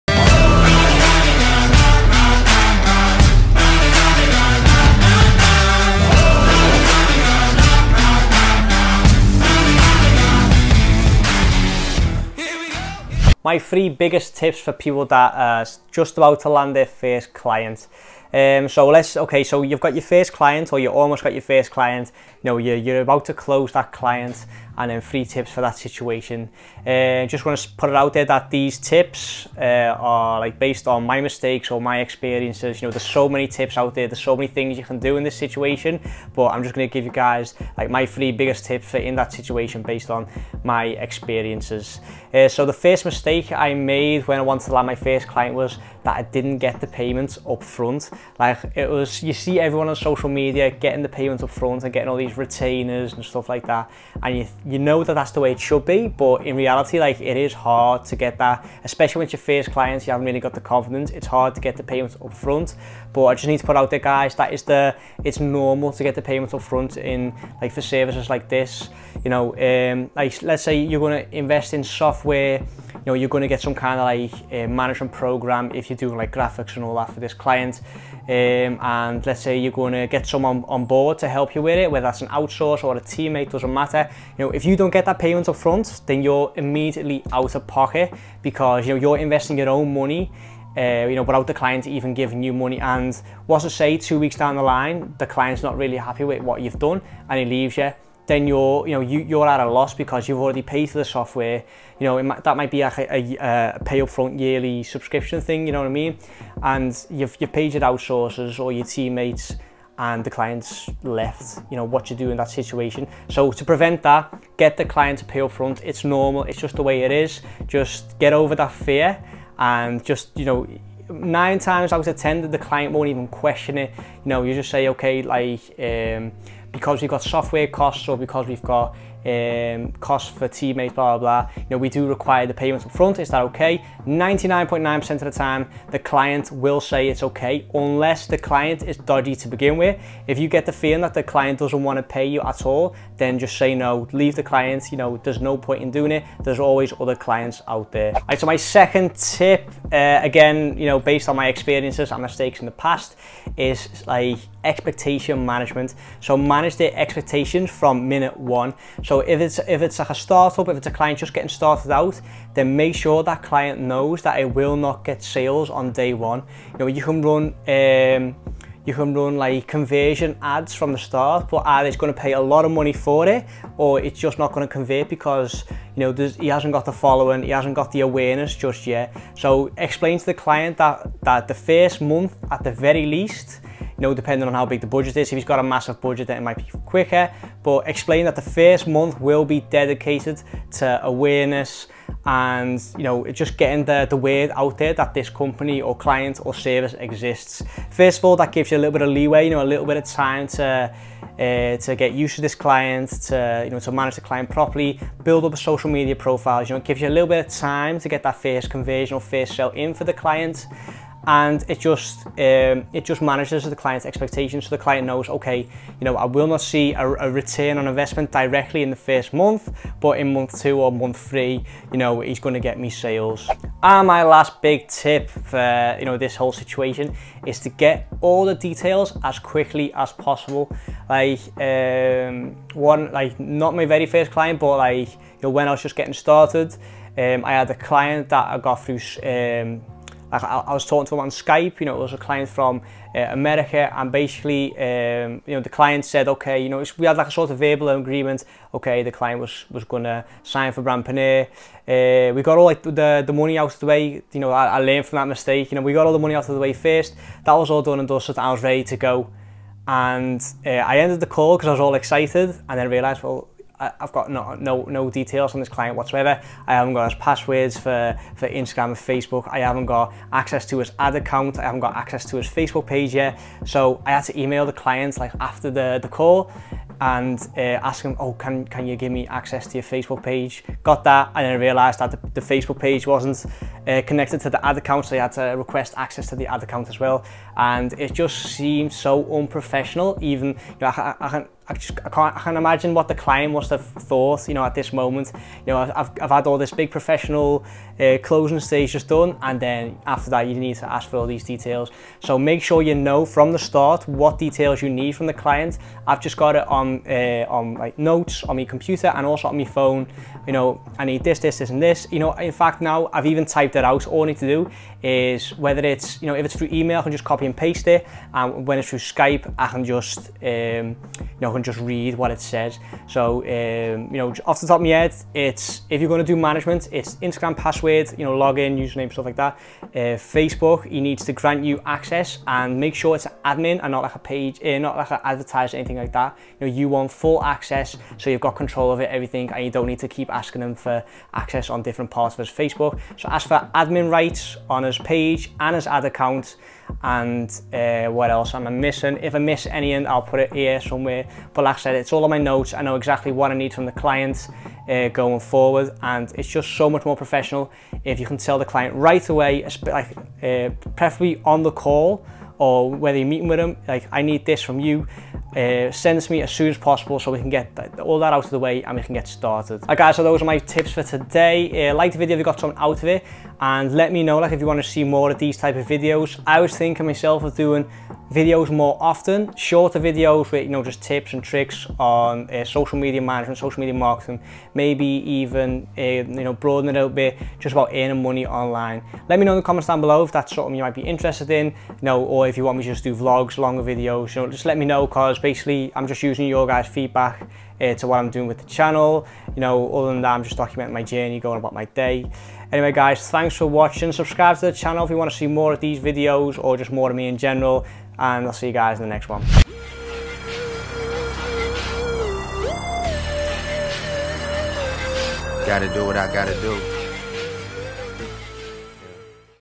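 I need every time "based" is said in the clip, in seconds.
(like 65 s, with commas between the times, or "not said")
30 s, 39 s, 150 s.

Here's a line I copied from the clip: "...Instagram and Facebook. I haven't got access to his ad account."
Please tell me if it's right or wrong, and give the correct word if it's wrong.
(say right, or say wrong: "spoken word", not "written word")
right.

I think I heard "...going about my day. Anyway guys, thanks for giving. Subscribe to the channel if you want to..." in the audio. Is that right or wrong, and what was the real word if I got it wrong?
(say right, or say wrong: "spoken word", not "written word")
wrong: "watching", not "giving".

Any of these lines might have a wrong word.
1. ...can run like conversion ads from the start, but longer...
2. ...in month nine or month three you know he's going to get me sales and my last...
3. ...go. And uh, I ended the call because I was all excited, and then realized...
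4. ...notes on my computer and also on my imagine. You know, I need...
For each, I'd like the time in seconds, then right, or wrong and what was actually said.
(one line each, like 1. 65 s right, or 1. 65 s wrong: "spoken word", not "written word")
1. 168 s wrong: "either", not "longer"
2. 220 s wrong: "two", not "nine"
3. 258 s right
4. 307 s wrong: "phone", not "imagine".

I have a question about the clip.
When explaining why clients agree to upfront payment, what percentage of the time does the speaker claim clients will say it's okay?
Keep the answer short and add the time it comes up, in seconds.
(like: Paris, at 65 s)
99.9%, at 134 s.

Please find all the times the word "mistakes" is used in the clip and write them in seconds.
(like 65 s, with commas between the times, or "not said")
31 s, 43 s, 152 s, 255 s.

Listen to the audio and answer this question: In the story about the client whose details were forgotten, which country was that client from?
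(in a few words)
America.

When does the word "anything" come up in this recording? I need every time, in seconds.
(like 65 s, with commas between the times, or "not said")
335 s, 349 s.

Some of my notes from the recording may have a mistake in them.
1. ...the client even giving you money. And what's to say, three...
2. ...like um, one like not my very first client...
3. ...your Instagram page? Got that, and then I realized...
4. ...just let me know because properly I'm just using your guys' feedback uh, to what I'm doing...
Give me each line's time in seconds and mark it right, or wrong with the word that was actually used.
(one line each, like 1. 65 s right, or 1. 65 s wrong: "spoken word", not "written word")
1. 91 s wrong: "two", not "three"
2. 231 s right
3. 279 s wrong: "Facebook", not "Instagram"
4. 394 s wrong: "basically", not "properly".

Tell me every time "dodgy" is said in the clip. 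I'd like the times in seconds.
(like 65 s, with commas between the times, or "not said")
138 s.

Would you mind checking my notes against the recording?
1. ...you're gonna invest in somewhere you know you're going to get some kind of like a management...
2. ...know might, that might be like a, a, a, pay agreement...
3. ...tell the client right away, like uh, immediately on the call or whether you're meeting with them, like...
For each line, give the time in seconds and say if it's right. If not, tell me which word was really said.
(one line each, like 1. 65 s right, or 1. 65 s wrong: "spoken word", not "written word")
1. 70 s wrong: "software", not "somewhere"
2. 102 s wrong: "upfront", not "agreement"
3. 358 s wrong: "preferably", not "immediately".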